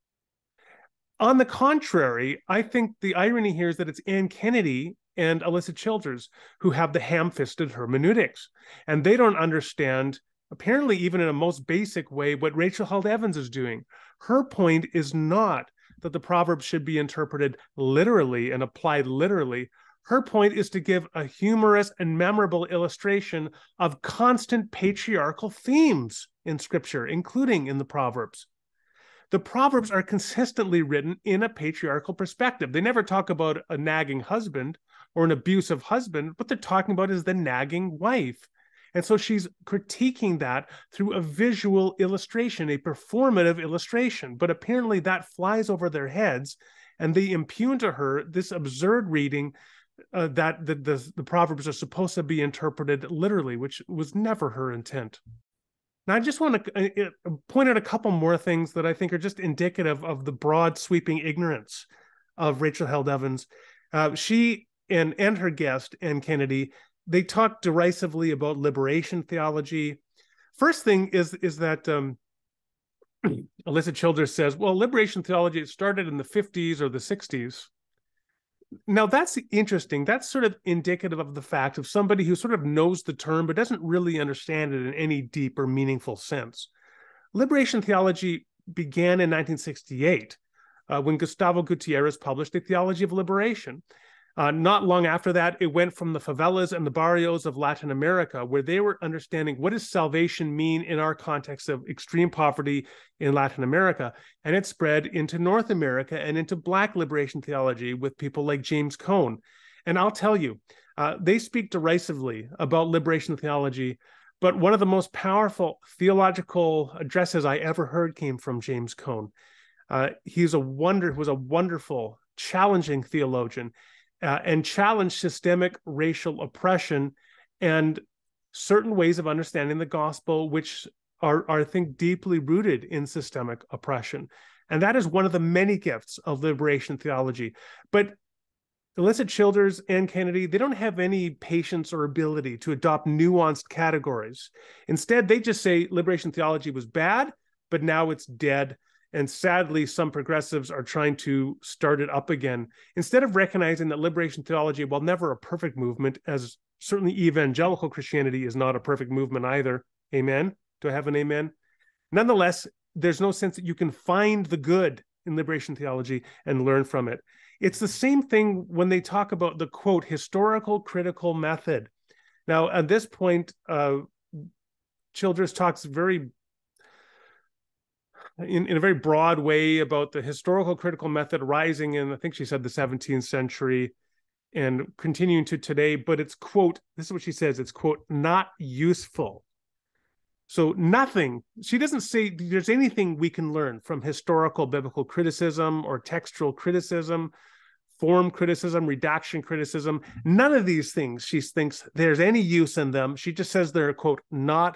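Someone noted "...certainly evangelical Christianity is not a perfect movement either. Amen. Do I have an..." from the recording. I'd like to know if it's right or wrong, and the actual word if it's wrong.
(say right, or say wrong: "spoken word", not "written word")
right.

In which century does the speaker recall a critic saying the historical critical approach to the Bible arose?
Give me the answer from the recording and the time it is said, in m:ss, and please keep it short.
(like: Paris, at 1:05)
17th century, at 3:02.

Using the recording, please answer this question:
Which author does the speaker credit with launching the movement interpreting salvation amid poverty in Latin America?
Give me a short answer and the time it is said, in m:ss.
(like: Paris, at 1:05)
Gustavo Gutierrez, at 1:31.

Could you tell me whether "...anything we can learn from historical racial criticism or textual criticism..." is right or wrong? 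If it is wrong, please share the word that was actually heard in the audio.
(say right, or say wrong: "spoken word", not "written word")
wrong: "biblical", not "racial".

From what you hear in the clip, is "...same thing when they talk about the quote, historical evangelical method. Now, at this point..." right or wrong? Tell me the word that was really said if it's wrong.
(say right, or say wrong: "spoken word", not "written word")
wrong: "critical", not "evangelical".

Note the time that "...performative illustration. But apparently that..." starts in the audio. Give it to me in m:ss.
0:42.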